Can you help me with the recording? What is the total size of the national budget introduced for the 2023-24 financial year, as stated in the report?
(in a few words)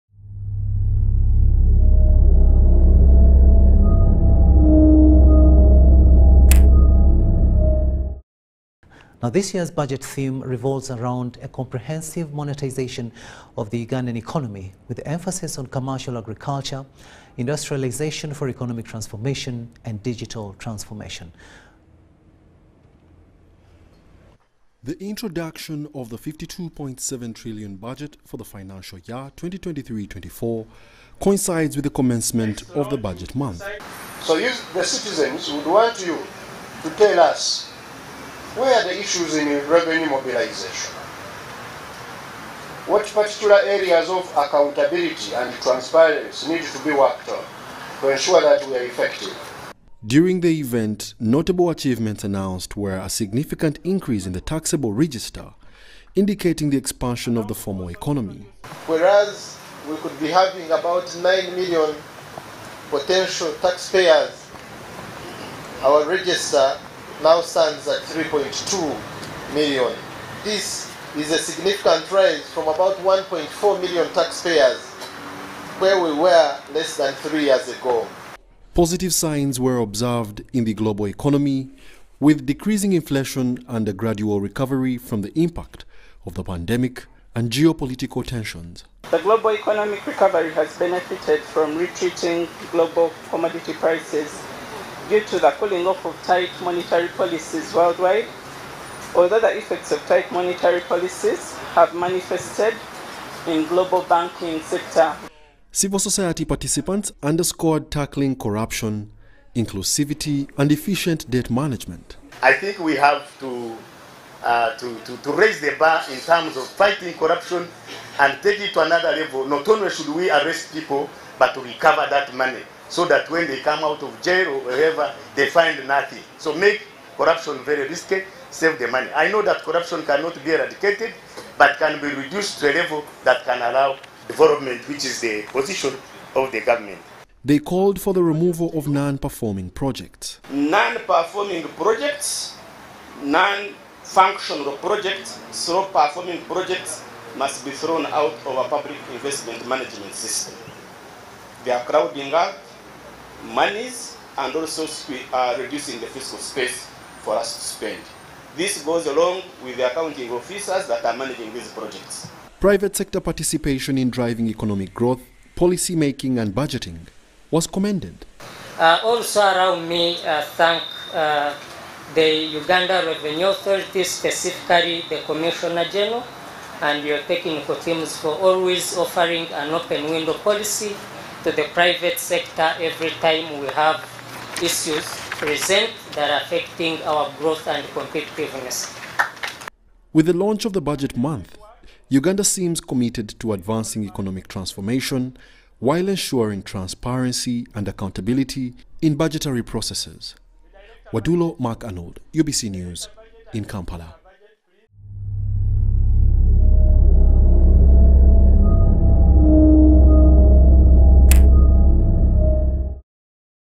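52.7 trillion.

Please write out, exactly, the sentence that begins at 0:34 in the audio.
So you, the citizens would want you to tell us where are the issues in revenue mobilization?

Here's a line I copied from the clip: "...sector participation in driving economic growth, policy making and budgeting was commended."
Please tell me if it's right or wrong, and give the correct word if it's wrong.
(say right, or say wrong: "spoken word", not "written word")
right.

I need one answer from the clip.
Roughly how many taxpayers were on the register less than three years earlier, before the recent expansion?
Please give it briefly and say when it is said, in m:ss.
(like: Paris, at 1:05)
1.4 million, at 1:12.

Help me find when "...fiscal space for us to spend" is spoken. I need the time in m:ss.
2:36.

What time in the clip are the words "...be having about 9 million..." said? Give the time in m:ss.
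1:00.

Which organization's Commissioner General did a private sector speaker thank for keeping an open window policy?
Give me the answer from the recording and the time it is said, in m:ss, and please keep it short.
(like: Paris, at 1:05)
Uganda Revenue Authority, at 2:52.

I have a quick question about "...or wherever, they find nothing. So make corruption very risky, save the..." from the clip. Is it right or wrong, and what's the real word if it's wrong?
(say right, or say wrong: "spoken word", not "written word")
right.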